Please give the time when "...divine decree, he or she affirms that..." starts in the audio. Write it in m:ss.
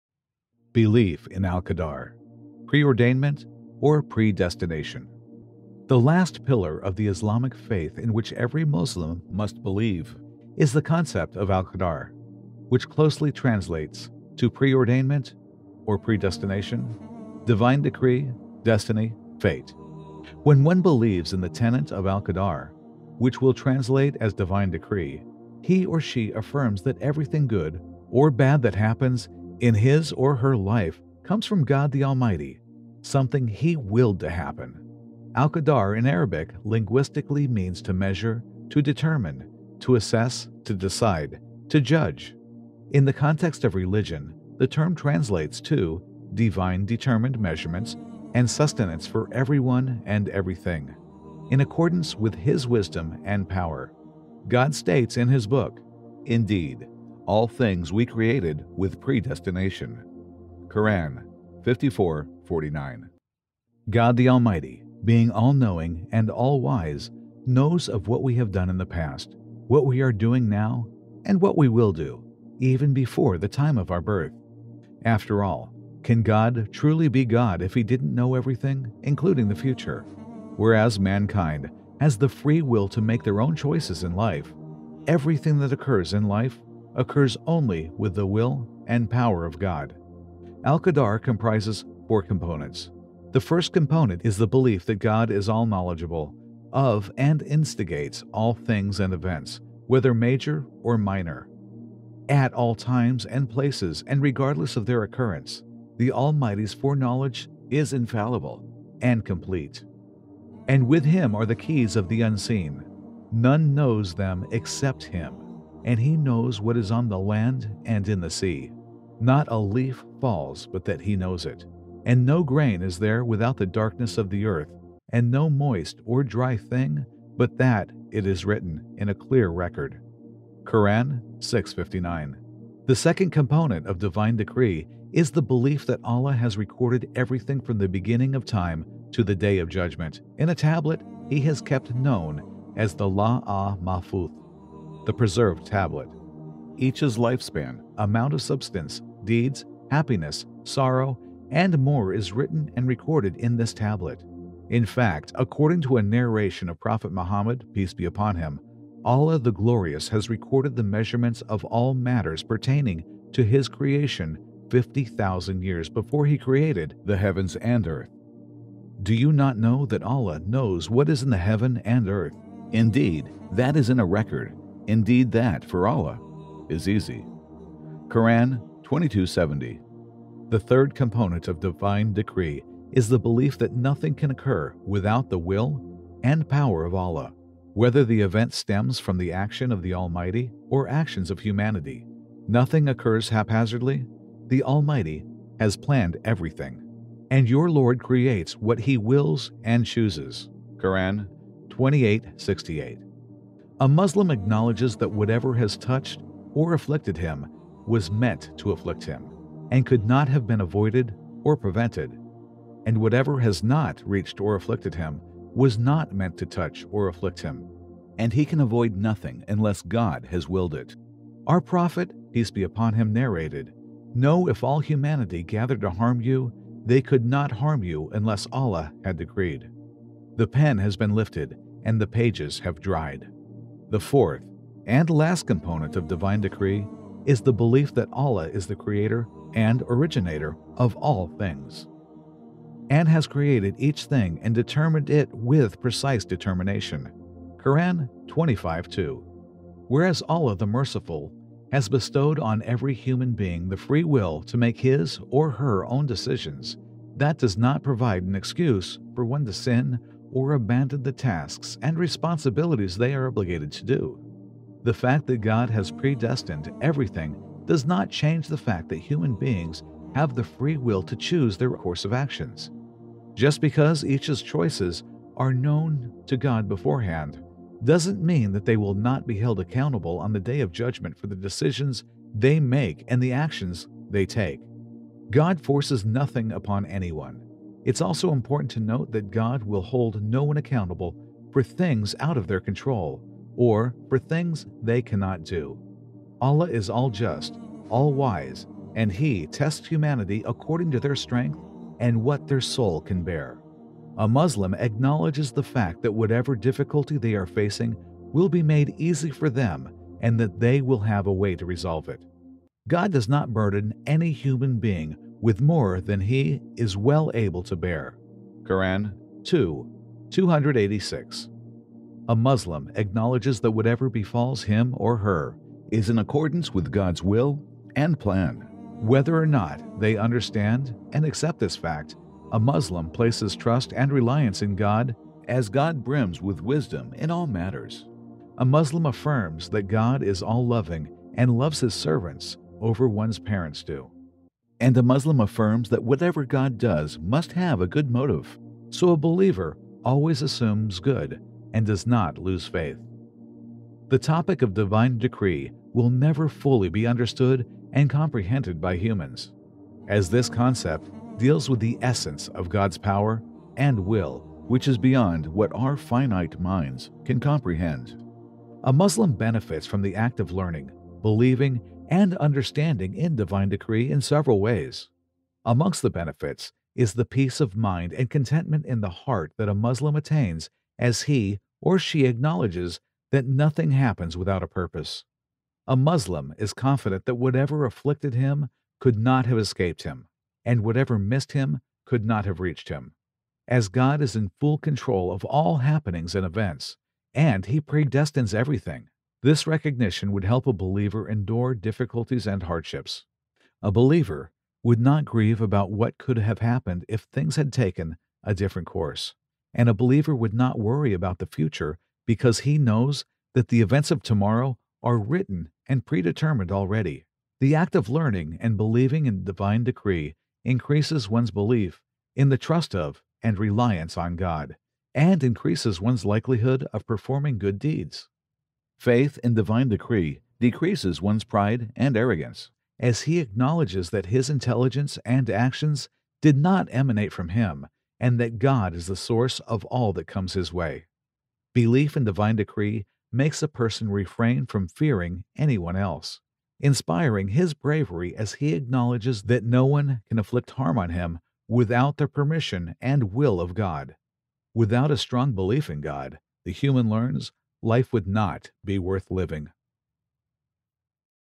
0:24.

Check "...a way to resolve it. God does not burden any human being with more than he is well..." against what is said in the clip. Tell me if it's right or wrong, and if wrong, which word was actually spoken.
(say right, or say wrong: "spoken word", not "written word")
right.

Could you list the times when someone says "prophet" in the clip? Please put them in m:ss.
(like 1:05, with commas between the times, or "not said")
2:36, 3:41.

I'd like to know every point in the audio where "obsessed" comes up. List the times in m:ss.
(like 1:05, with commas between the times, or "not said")
not said.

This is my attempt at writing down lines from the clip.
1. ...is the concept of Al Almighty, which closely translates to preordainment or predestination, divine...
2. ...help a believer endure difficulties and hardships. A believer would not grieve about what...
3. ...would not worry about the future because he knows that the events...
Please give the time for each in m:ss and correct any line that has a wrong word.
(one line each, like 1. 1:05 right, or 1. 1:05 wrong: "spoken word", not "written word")
1. 0:10 wrong: "Qadar", not "Almighty"
2. 6:40 right
3. 6:50 right.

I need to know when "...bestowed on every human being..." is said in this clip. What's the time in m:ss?
4:11.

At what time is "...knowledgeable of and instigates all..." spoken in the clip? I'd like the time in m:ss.
1:35.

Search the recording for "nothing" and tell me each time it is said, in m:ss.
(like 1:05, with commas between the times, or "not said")
3:03, 3:12, 3:38, 4:46, 6:23.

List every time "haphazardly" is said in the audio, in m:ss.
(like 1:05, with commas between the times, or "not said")
3:13.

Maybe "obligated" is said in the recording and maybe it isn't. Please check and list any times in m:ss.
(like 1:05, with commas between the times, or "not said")
4:23.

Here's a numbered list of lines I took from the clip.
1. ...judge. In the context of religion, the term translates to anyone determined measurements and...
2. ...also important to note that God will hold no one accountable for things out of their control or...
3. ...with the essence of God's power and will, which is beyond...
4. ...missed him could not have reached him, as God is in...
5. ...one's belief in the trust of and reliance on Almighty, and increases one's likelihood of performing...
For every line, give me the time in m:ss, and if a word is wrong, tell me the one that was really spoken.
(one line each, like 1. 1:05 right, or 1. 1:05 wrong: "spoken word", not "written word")
1. 0:41 wrong: "divine", not "anyone"
2. 4:48 right
3. 6:01 right
4. 6:31 right
5. 7:01 wrong: "God", not "Almighty".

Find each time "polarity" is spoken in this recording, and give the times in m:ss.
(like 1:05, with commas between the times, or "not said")
not said.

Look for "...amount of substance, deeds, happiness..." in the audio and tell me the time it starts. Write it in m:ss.
2:27.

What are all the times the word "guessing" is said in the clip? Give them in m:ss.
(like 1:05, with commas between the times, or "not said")
not said.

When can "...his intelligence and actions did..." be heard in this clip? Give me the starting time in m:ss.
7:14.